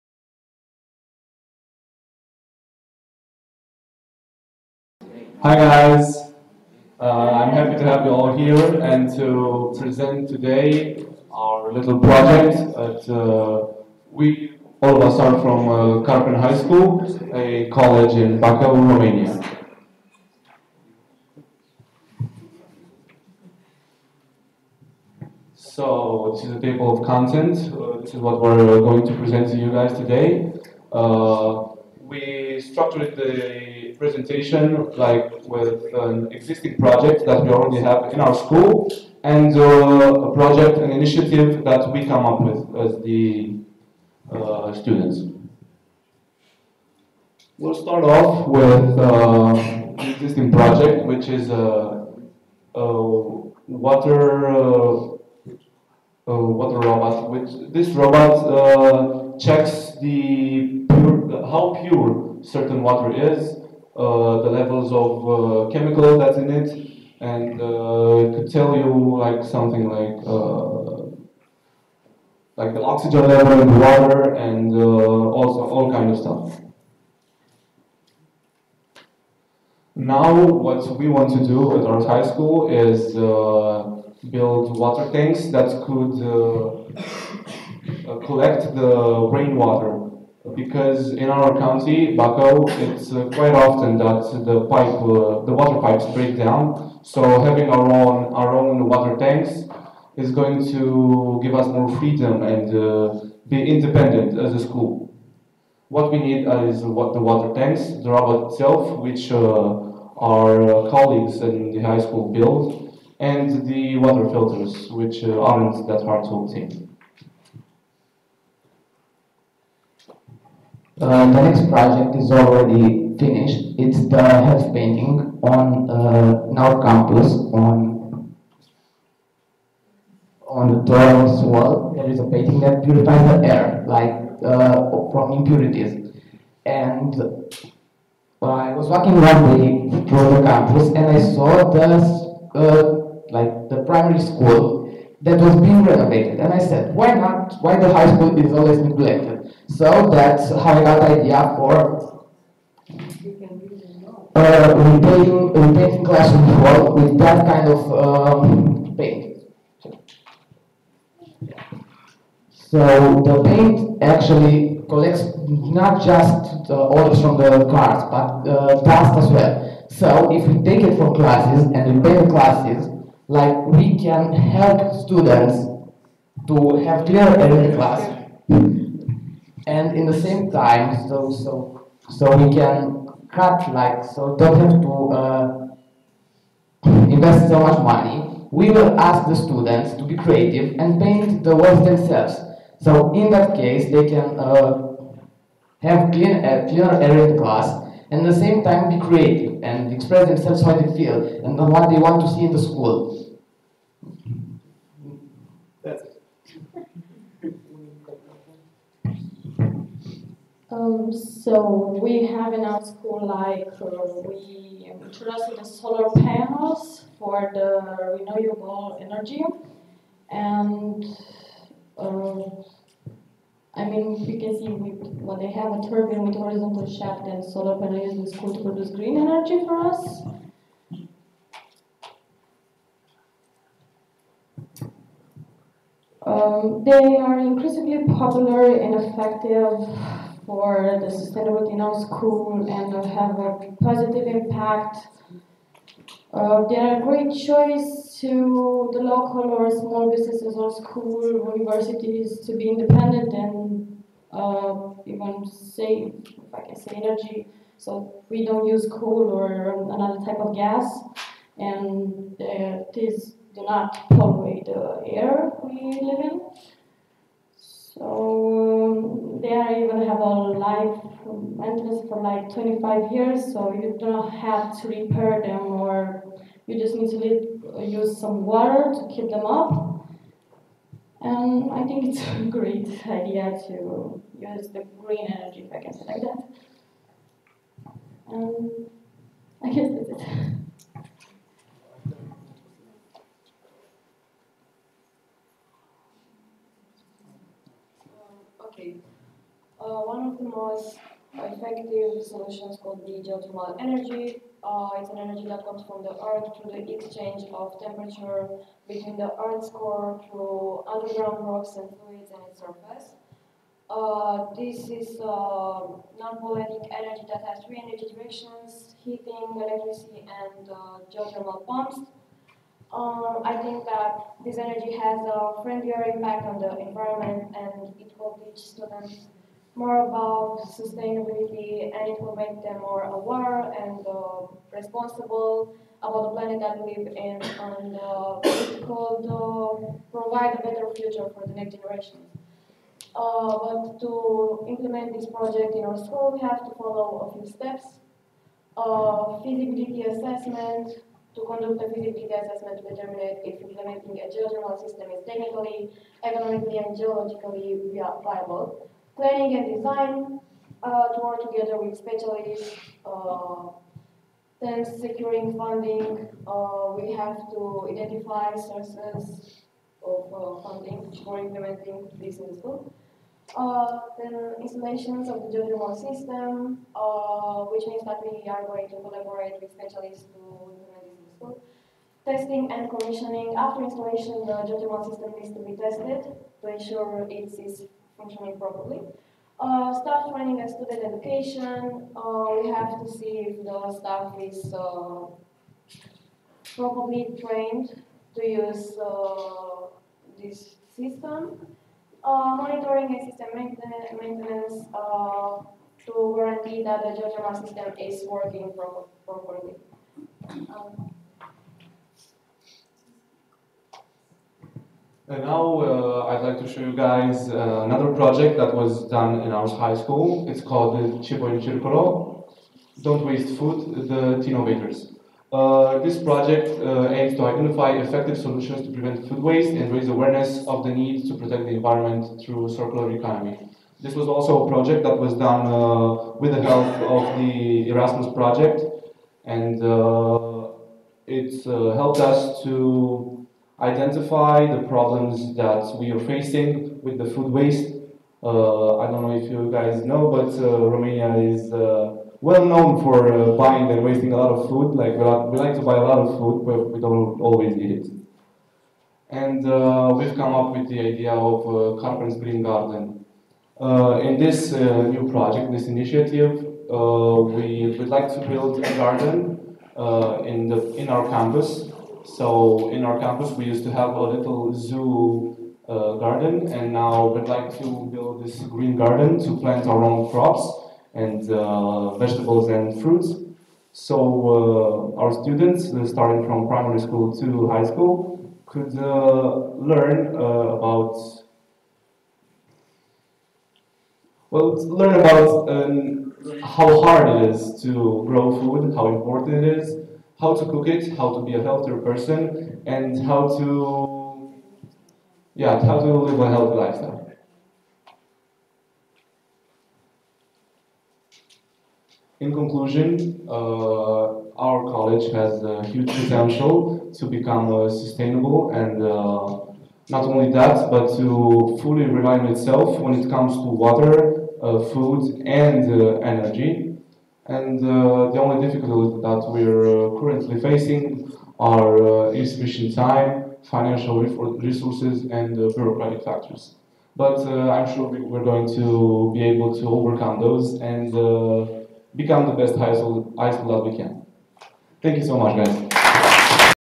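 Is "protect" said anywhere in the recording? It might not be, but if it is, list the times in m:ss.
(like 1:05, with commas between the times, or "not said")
7:11.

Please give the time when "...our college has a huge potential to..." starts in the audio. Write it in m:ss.
8:34.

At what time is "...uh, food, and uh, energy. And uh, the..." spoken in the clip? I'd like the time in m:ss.
8:44.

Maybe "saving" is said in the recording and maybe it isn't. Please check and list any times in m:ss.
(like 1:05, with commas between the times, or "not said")
not said.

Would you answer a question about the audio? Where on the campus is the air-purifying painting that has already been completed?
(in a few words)
the dorms wall.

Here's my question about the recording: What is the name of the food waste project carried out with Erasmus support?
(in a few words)
Cibo in Circolo.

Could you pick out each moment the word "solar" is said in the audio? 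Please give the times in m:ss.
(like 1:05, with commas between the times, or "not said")
3:35, 3:47.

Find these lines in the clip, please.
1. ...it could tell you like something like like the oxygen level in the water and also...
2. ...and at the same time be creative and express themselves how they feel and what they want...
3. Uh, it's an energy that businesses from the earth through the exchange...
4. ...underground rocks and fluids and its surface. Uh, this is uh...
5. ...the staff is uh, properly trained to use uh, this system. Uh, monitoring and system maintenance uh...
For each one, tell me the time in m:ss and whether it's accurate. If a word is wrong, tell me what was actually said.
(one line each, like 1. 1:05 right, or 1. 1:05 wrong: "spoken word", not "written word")
1. 1:08 right
2. 3:18 right
3. 5:04 wrong: "comes", not "businesses"
4. 5:10 right
5. 6:33 right.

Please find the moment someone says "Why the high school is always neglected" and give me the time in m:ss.
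2:27.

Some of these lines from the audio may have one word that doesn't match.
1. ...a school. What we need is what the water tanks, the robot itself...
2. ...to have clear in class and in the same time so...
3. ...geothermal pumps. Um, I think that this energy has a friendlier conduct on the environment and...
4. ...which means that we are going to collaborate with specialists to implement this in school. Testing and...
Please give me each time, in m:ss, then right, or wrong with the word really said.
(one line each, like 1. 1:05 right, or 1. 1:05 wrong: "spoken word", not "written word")
1. 1:44 right
2. 2:56 right
3. 5:21 wrong: "impact", not "conduct"
4. 6:17 right.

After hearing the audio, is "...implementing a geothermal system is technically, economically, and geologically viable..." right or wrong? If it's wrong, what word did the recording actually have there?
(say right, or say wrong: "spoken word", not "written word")
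right.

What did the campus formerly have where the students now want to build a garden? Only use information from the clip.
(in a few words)
a little zoo.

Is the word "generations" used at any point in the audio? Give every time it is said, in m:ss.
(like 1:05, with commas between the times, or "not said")
5:41.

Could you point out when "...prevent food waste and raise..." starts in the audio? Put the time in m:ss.
7:08.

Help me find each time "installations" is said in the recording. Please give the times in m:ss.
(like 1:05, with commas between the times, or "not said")
6:14, 6:23.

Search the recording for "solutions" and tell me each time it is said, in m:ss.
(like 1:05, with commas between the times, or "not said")
5:02, 7:08.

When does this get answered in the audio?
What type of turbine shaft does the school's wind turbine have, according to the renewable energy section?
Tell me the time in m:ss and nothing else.
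3:46.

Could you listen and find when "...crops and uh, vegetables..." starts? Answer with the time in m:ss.
8:00.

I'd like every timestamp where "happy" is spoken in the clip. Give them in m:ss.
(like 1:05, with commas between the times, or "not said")
0:07.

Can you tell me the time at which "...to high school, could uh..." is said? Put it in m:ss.
8:07.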